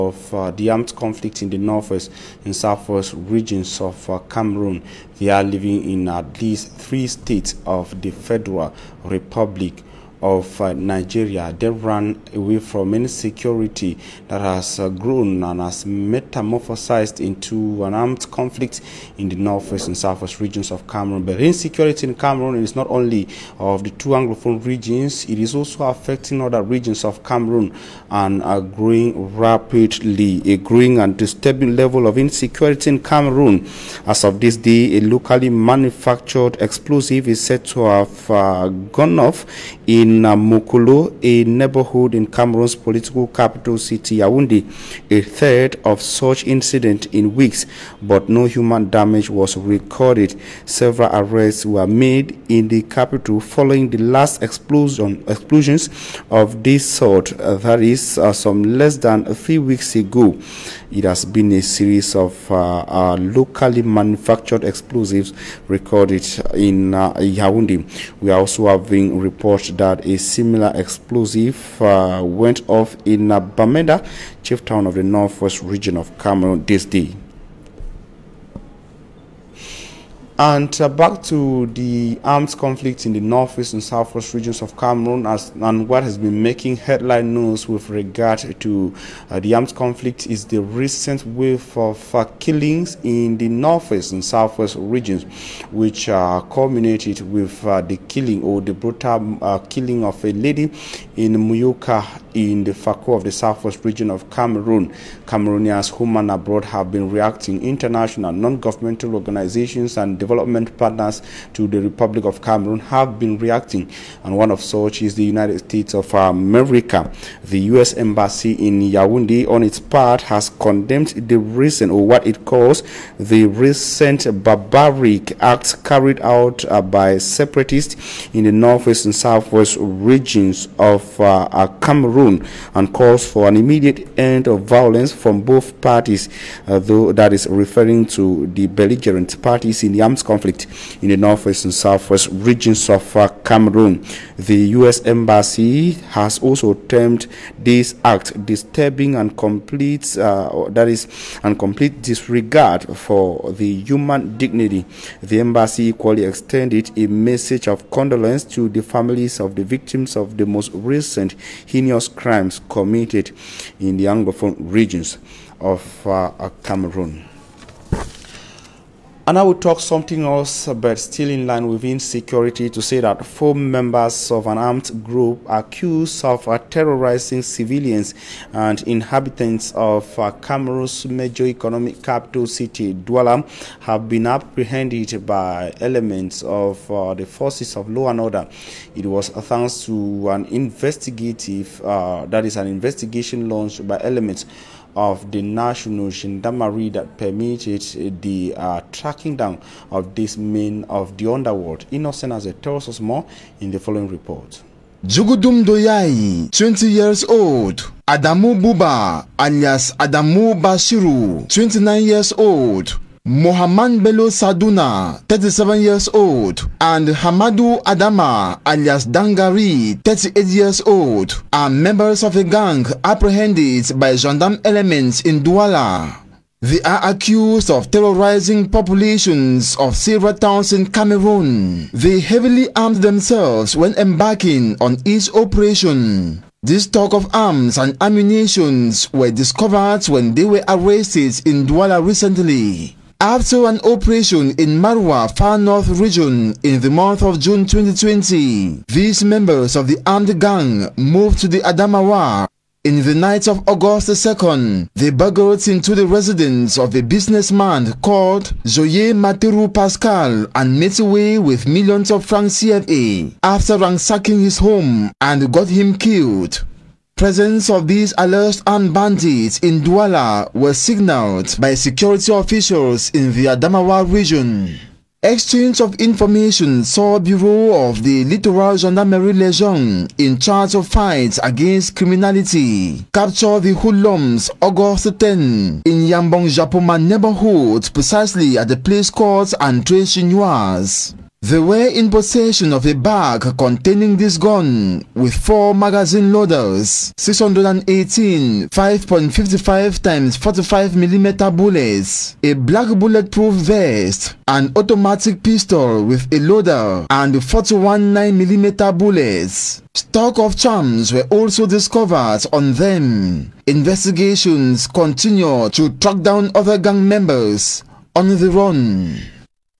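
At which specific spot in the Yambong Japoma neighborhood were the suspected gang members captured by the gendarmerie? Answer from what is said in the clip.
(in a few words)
André Chinoise.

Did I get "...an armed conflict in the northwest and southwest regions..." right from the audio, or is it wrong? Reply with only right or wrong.
right.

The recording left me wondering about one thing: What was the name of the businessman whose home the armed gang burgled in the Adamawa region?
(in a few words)
Joye Materu Pascal.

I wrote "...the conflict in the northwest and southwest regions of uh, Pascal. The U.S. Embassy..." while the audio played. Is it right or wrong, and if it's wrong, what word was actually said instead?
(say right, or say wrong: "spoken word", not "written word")
wrong: "Cameroon", not "Pascal".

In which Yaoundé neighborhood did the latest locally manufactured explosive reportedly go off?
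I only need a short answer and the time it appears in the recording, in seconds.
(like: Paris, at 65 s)
Namukulu, at 40 s.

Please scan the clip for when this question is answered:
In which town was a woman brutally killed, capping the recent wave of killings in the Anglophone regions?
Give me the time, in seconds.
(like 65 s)
101 s.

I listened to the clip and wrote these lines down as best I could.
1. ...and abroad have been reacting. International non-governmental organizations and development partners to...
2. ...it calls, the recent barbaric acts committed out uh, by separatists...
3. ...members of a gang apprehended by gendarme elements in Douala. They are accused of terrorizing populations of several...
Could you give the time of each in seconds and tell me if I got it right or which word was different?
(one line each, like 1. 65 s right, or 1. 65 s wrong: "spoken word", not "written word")
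1. 106 s right
2. 122 s wrong: "carried", not "committed"
3. 221 s right.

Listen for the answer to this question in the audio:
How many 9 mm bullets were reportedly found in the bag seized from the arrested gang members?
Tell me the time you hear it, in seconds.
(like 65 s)
307 s.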